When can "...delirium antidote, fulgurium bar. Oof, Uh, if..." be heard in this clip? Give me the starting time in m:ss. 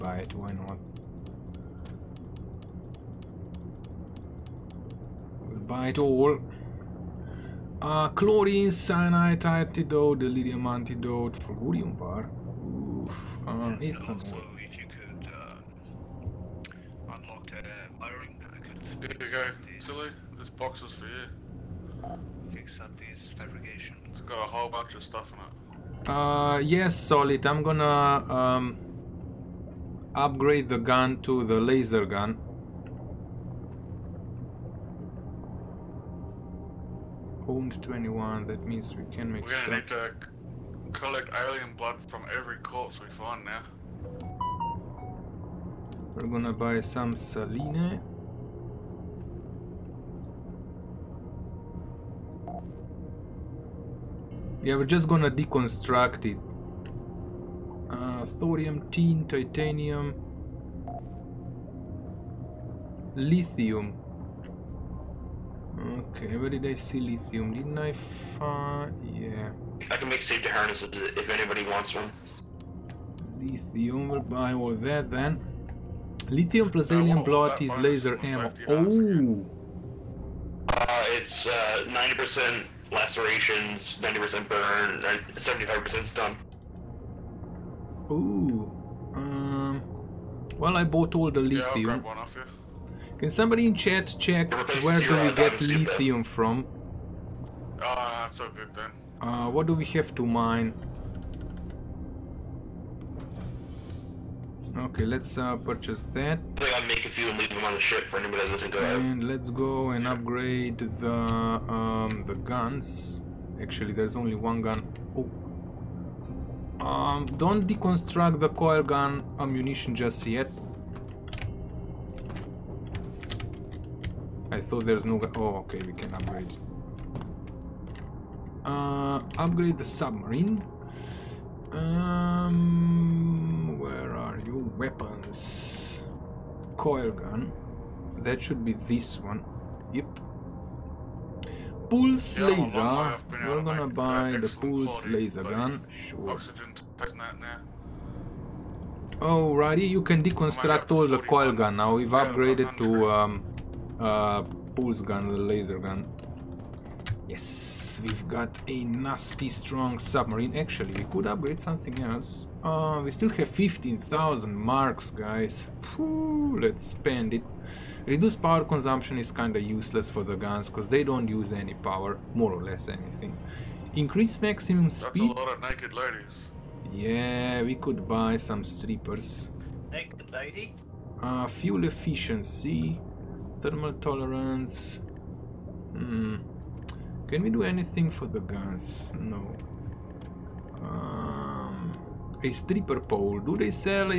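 0:10.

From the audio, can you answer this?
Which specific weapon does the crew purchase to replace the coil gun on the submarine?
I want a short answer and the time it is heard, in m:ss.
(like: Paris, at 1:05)
Pulse laser gun, at 2:24.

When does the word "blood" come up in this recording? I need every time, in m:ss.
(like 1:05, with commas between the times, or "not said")
0:41, 1:17.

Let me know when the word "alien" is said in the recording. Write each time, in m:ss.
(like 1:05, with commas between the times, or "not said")
0:41, 1:16.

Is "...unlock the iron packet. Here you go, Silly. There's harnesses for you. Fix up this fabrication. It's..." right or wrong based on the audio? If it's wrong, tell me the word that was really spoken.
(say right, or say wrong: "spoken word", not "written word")
wrong: "boxes", not "harnesses".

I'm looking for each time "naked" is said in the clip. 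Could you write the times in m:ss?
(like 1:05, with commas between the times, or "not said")
2:55, 2:59.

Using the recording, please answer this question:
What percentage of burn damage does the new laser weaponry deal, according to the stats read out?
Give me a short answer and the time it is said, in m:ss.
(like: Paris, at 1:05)
90%, at 1:24.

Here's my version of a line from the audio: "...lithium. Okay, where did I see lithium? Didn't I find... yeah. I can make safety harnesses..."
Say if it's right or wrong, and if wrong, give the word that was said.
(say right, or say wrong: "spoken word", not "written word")
right.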